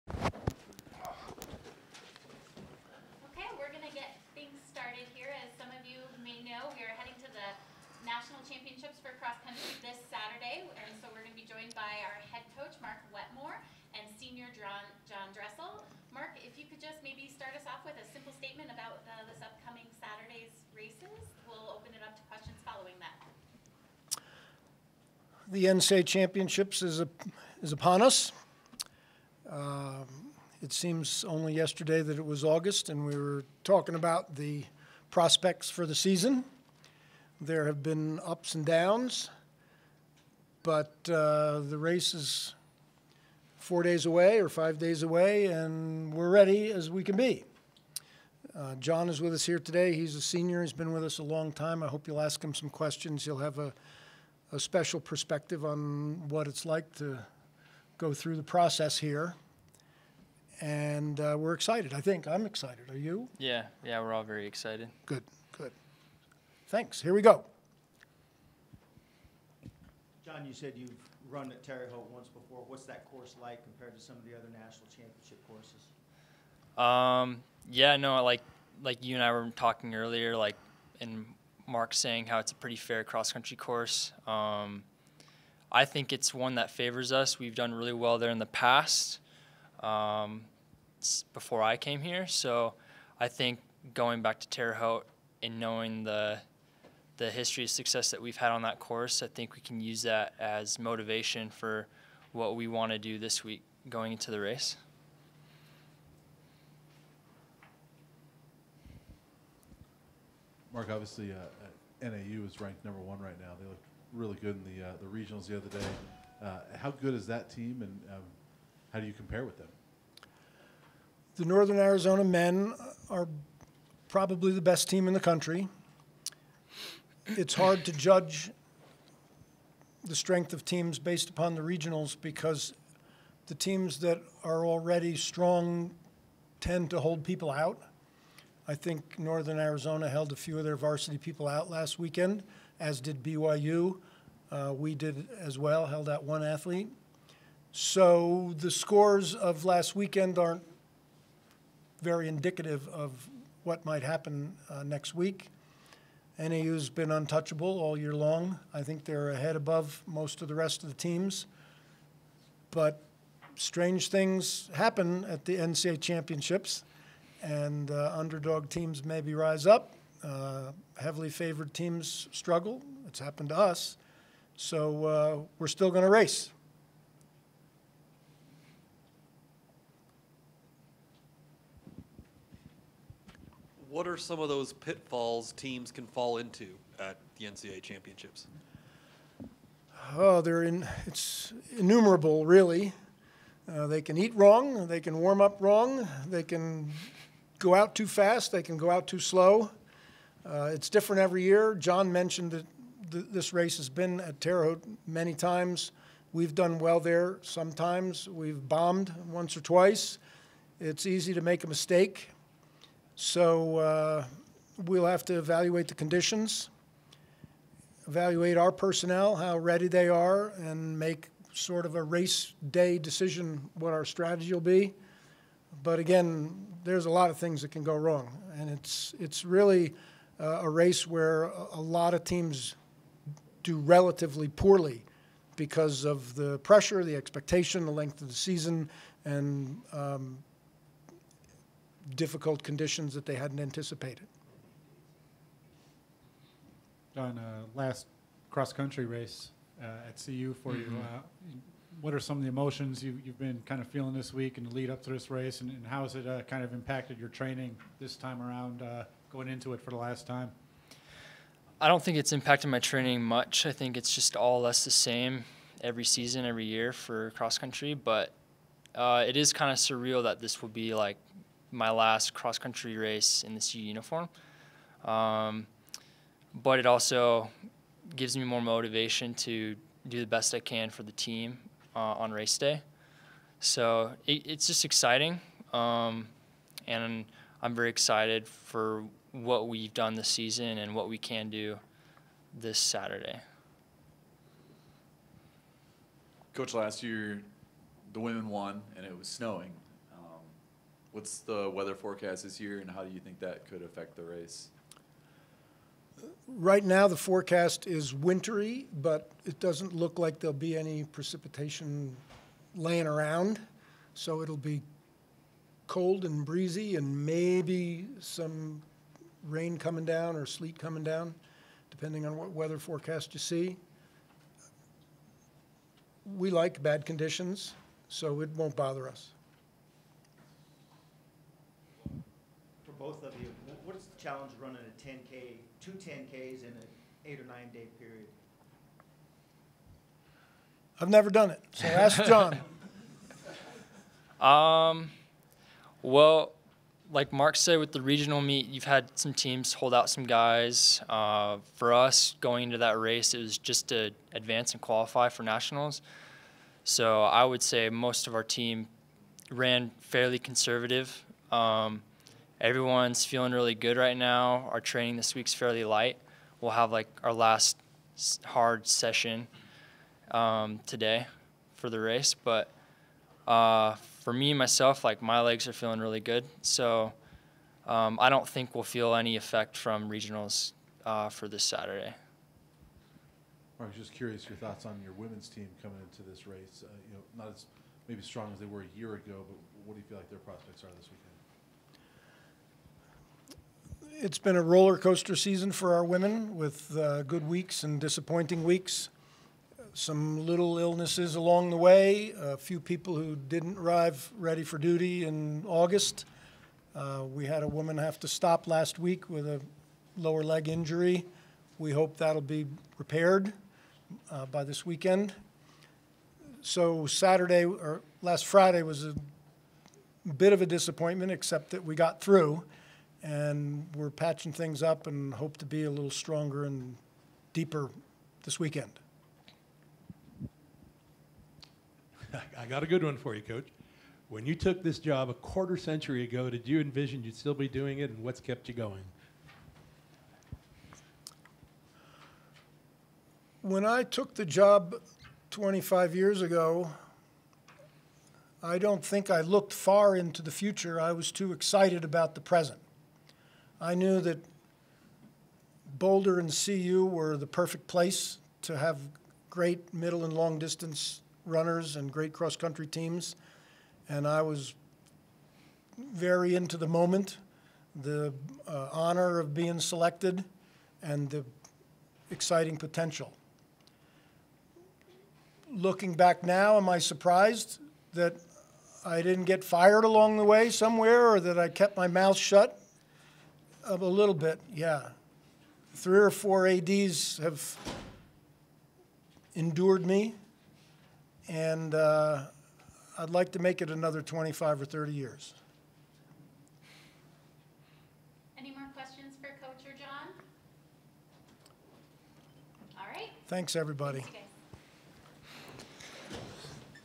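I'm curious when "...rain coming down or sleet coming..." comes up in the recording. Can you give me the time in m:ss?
5:19.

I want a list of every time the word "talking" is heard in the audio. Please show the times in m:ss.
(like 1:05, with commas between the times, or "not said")
0:33, 1:19.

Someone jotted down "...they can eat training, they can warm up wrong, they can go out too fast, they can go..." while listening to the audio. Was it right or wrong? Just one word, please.
wrong.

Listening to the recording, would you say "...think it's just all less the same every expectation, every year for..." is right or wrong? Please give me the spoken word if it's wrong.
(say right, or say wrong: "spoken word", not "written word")
wrong: "season", not "expectation".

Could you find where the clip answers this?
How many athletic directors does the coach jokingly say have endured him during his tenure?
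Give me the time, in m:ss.
8:05.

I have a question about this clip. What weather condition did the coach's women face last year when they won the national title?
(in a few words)
Snowing.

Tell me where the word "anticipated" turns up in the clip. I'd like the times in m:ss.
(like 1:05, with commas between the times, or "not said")
4:03.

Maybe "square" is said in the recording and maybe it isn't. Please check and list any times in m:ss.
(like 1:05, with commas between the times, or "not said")
not said.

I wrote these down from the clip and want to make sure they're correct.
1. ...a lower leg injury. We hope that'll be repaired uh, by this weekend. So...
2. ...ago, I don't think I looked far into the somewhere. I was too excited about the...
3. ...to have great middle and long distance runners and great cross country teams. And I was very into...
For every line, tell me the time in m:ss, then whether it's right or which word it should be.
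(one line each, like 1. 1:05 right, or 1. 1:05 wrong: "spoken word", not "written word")
1. 6:49 right
2. 7:26 wrong: "future", not "somewhere"
3. 7:38 right.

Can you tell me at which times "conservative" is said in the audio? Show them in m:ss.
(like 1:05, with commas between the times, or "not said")
6:00.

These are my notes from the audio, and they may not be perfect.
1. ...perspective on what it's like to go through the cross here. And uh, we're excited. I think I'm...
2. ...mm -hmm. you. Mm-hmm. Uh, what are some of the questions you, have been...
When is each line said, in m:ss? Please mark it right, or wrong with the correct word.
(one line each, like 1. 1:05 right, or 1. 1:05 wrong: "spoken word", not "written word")
1. 0:54 wrong: "process", not "cross"
2. 4:10 wrong: "emotions", not "questions".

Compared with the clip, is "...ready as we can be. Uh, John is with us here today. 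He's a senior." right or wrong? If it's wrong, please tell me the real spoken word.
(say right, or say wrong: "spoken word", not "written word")
right.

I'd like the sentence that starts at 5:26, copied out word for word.
We like bad conditions, so it won't bother us.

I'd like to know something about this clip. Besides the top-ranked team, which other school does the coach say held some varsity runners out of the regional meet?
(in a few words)
BYU.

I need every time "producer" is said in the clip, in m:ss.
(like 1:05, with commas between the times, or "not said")
not said.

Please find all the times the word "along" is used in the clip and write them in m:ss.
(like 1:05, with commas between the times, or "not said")
6:41, 8:00.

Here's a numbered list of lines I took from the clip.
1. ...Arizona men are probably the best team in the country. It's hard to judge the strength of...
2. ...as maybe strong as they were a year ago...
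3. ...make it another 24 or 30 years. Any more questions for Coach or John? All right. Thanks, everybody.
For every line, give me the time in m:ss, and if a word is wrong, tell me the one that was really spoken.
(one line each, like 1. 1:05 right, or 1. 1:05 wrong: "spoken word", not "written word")
1. 2:01 right
2. 6:27 right
3. 8:13 wrong: "25", not "24".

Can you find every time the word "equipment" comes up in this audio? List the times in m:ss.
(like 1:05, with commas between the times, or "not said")
not said.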